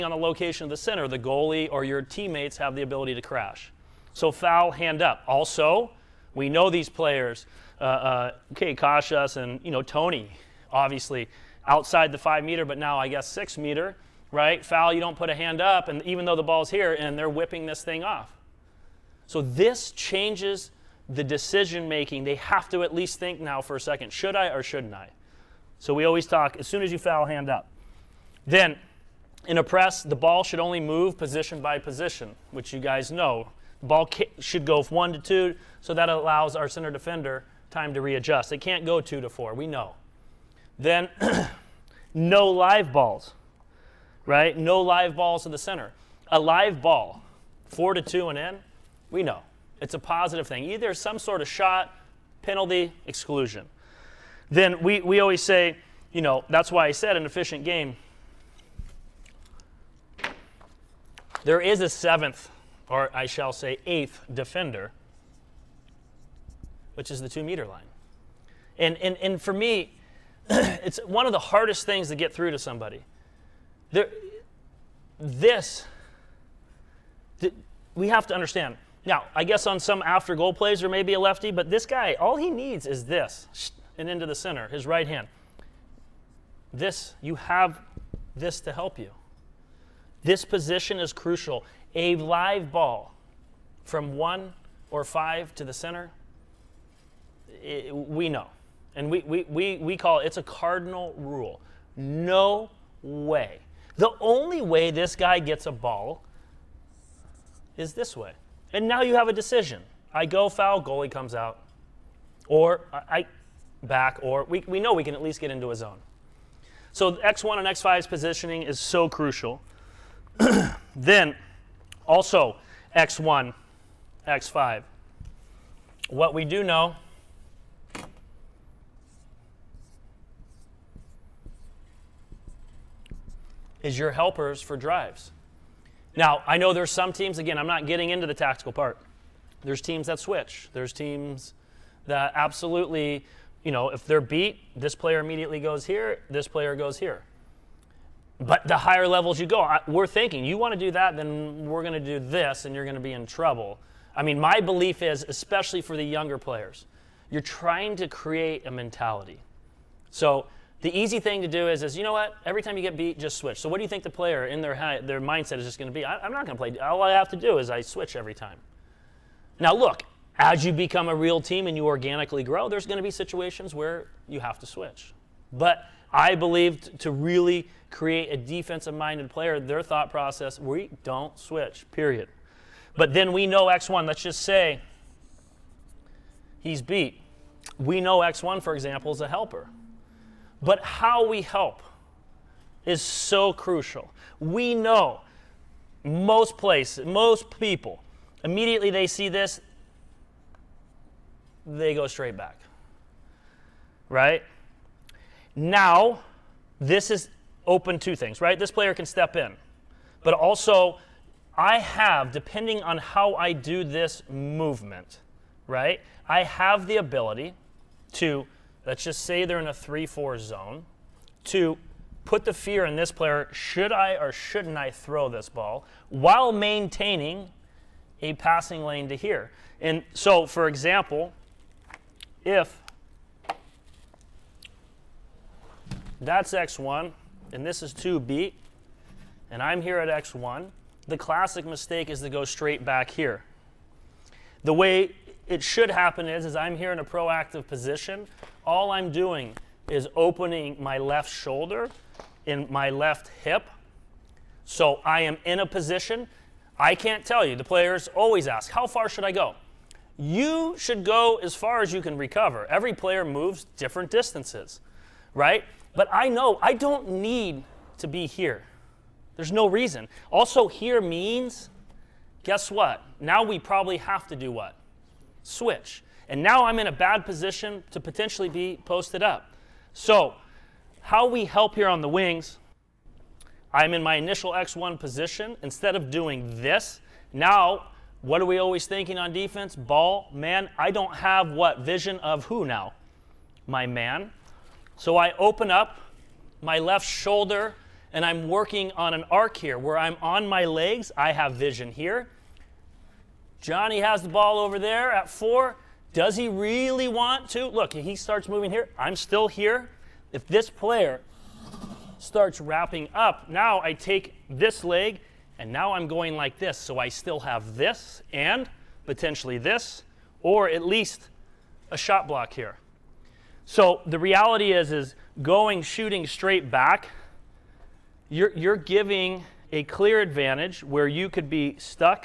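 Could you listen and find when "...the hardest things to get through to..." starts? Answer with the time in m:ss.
1:11.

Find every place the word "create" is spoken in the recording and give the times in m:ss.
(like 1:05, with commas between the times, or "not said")
2:38, 2:57.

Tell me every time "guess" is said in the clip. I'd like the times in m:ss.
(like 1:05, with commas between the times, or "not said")
0:13, 1:19, 4:32.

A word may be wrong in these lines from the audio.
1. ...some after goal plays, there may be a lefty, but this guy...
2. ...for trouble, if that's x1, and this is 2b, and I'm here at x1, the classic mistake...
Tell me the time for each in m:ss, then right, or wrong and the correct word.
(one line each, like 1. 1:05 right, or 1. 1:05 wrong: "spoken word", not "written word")
1. 1:19 right
2. 3:50 wrong: "example", not "trouble".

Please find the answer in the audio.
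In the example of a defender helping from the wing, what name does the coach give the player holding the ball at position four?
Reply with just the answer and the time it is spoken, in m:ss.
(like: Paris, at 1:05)
Johnny, at 5:03.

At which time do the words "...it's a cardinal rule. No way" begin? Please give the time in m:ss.
1:40.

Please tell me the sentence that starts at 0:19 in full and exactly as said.
So this changes the decision making, they have to at least think now for a second should I or shouldn't I?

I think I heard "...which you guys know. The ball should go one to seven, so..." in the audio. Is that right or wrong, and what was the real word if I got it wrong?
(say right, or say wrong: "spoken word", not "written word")
wrong: "two", not "seven".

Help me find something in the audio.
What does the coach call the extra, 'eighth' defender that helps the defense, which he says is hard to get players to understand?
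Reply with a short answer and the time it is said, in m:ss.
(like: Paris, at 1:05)
two meter line, at 1:07.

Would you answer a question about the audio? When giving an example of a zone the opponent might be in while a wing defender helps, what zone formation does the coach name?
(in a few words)
3-4 zone.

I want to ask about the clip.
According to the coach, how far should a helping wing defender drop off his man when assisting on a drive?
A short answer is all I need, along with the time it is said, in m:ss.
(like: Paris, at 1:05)
As far as you can recover, at 4:21.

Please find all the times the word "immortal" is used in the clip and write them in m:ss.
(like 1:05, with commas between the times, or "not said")
not said.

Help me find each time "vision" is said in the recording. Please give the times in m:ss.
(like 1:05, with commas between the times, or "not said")
4:51, 5:01.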